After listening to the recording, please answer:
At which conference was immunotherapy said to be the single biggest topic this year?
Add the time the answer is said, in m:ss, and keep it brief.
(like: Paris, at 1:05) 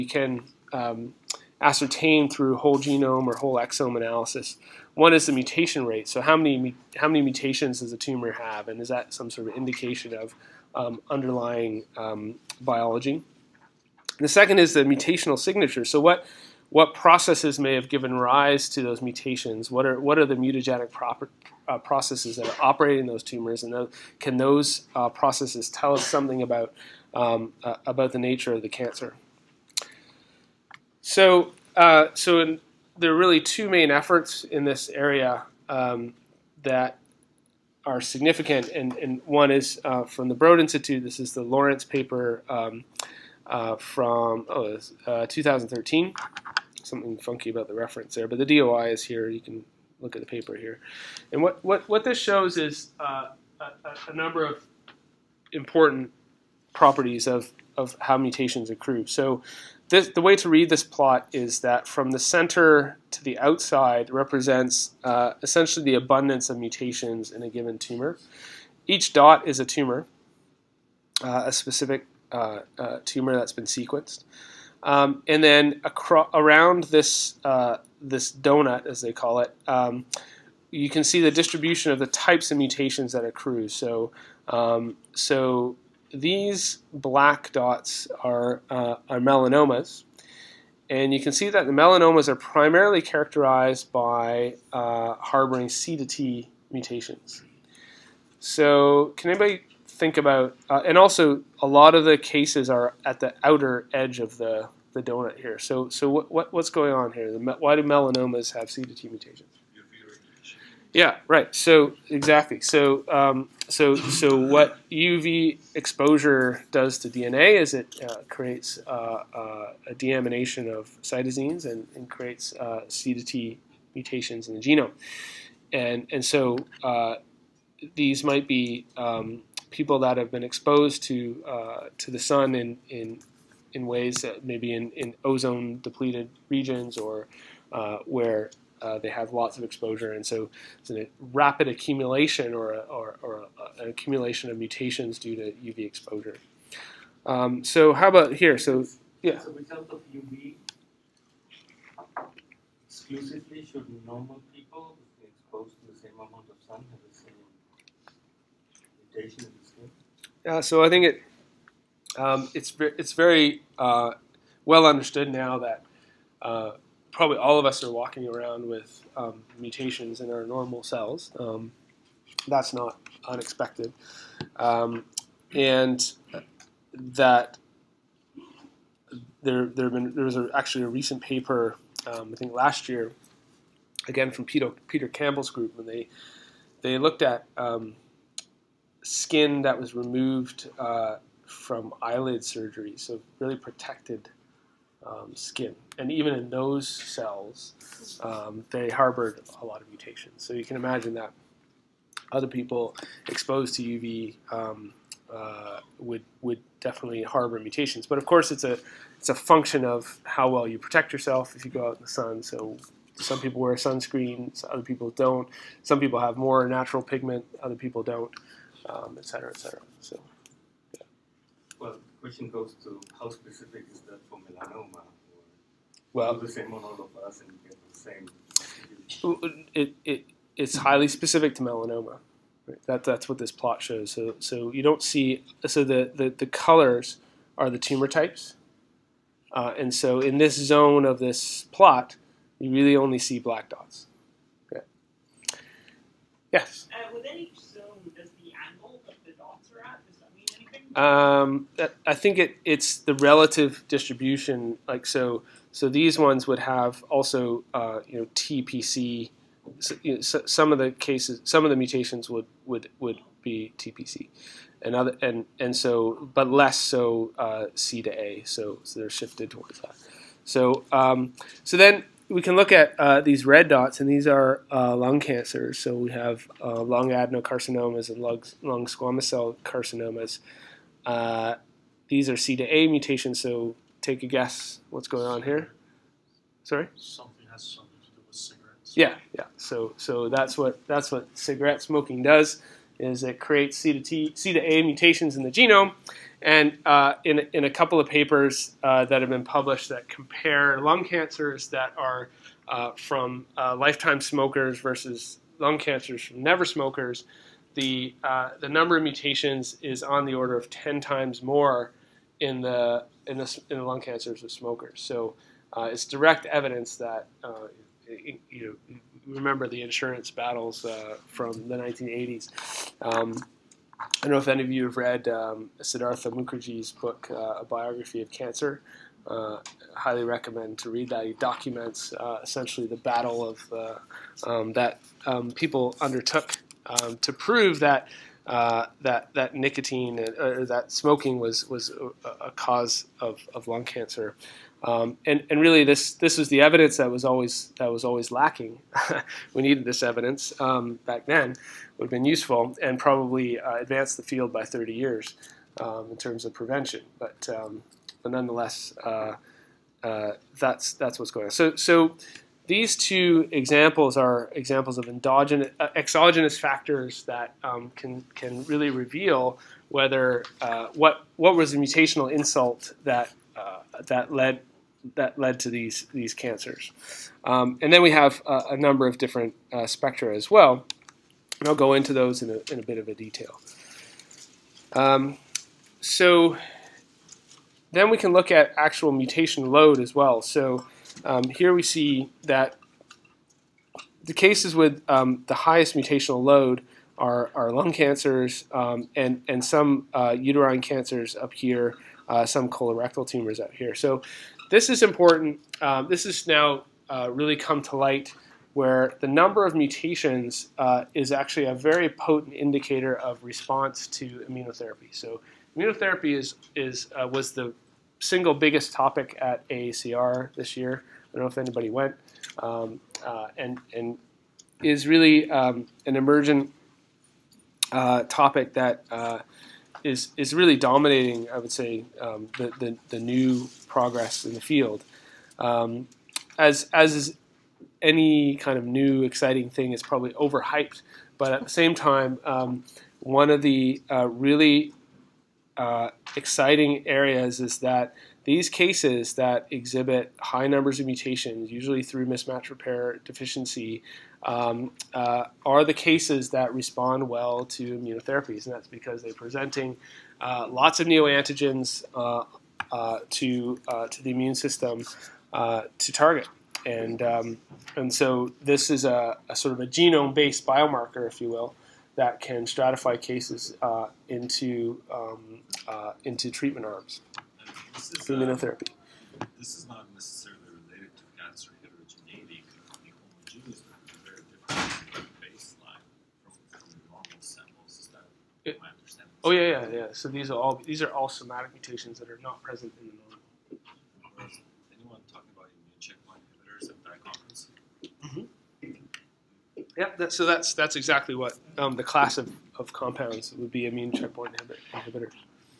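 AACR, at 6:59.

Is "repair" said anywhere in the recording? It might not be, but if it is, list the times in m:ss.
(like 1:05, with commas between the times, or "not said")
7:32.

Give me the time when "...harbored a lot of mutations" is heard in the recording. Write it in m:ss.
3:18.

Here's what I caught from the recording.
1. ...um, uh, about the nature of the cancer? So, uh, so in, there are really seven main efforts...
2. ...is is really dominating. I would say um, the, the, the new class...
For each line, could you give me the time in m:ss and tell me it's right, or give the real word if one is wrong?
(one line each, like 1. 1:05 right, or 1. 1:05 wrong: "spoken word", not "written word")
1. 0:27 wrong: "two", not "seven"
2. 7:10 wrong: "progress", not "class".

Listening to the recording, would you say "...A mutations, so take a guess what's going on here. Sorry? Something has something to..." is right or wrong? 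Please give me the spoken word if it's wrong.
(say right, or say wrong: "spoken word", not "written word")
right.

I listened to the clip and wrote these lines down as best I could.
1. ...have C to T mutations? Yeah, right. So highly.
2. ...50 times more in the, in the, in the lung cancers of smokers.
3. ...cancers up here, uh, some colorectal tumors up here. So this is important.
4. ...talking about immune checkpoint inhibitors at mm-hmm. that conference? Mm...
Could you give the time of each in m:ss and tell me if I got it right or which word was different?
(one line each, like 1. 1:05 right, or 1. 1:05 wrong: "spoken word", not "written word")
1. 1:48 wrong: "exactly", not "highly"
2. 5:10 wrong: "10", not "50"
3. 6:40 right
4. 8:15 right.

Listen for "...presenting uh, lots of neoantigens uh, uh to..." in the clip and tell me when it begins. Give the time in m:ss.
7:39.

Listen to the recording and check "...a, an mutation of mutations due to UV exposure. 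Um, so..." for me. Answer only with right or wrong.
wrong.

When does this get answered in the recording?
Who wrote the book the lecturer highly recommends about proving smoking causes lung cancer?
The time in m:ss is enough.
5:25.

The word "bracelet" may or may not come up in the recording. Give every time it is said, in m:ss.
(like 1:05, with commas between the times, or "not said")
not said.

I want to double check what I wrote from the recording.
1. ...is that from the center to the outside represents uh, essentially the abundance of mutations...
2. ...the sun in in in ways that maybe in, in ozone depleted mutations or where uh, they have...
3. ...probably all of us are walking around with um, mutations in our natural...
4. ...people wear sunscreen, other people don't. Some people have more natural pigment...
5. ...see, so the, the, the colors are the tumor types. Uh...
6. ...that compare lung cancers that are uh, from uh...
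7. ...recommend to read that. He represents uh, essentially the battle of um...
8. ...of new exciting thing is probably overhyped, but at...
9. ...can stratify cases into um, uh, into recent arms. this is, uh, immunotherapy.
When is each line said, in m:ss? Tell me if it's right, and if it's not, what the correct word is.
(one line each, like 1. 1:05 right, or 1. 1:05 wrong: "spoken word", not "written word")
1. 1:01 right
2. 2:12 wrong: "regions", not "mutations"
3. 2:47 wrong: "normal", not "natural"
4. 3:33 right
5. 3:55 right
6. 4:59 right
7. 5:30 wrong: "documents", not "represents"
8. 7:18 right
9. 7:52 wrong: "treatment", not "recent".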